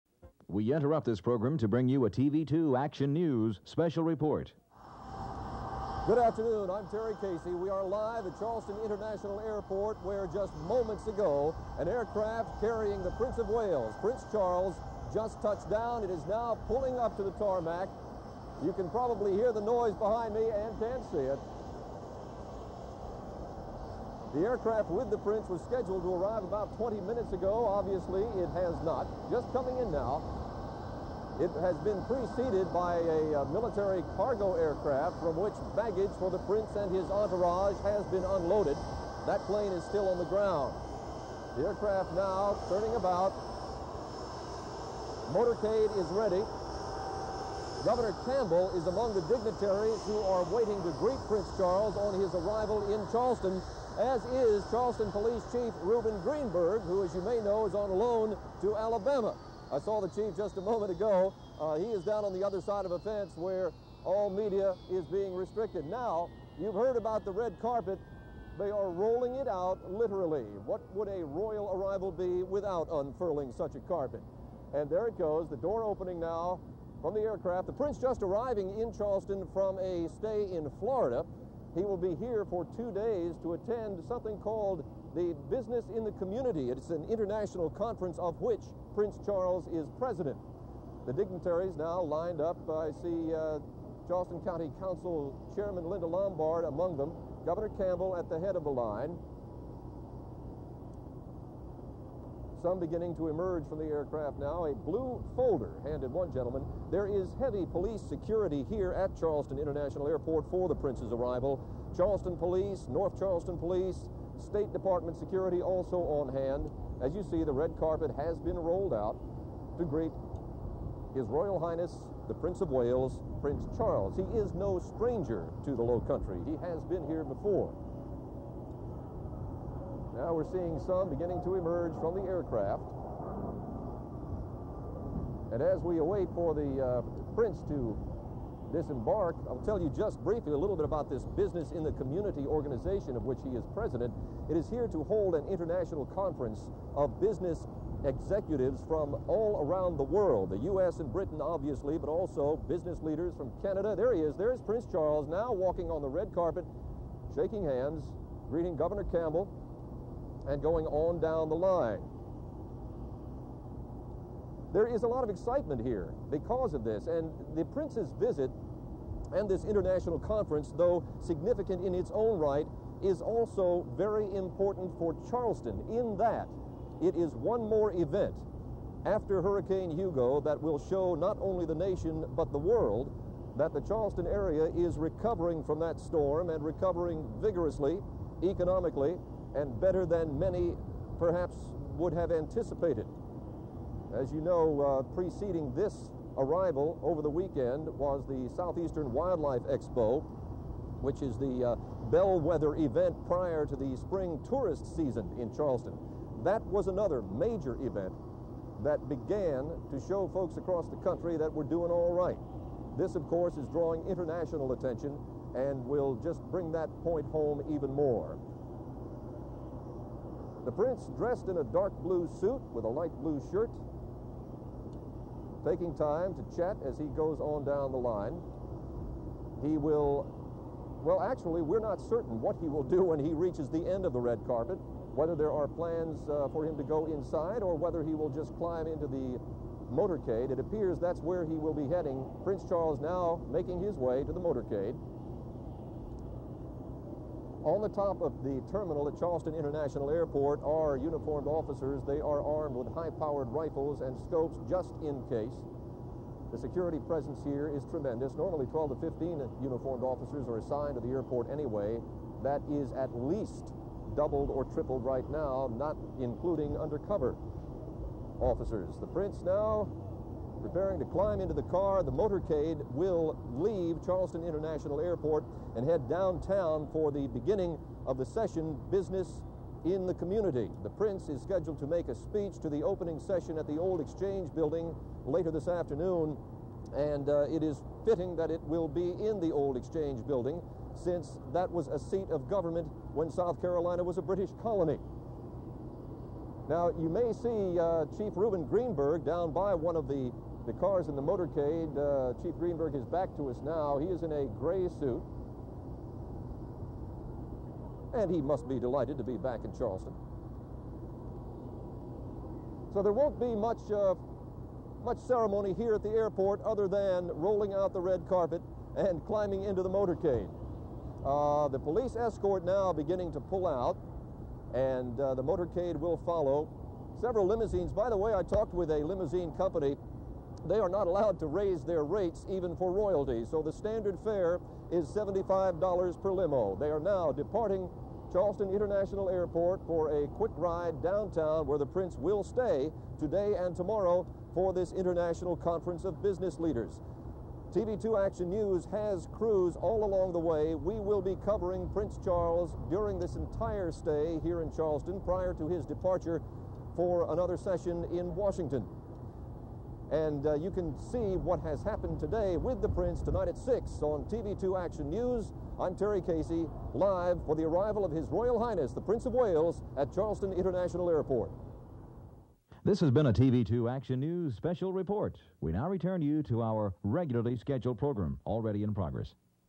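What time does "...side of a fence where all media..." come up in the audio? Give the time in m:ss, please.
1:02.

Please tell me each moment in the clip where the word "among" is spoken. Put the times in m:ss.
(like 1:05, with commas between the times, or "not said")
0:48, 1:36.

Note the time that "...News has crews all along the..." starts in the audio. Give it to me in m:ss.
5:48.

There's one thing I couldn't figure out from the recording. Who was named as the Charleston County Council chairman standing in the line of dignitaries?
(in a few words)
Linda Lombard.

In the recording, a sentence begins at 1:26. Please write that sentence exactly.
It's an international conference of which Prince Charles is president.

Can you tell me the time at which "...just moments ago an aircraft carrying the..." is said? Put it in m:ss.
0:10.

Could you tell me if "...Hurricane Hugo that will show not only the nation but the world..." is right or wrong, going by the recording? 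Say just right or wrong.
right.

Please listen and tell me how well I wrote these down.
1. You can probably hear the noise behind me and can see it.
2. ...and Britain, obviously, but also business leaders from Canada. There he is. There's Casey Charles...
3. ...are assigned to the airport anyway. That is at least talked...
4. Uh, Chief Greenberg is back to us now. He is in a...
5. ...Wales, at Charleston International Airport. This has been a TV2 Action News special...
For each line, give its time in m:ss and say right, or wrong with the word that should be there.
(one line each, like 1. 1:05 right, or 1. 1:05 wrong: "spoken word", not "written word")
1. 0:18 right
2. 2:31 wrong: "Prince", not "Casey"
3. 4:20 wrong: "doubled", not "talked"
4. 5:01 right
5. 6:09 right.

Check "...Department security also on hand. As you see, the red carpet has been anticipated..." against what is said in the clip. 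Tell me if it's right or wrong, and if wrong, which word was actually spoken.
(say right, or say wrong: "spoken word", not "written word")
wrong: "rolled", not "anticipated".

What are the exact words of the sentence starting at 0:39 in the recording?
That plane is still on the ground.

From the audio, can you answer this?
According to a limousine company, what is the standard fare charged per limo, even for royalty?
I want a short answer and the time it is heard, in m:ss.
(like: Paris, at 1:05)
$75, at 5:35.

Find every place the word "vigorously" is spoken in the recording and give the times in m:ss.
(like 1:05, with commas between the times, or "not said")
3:07.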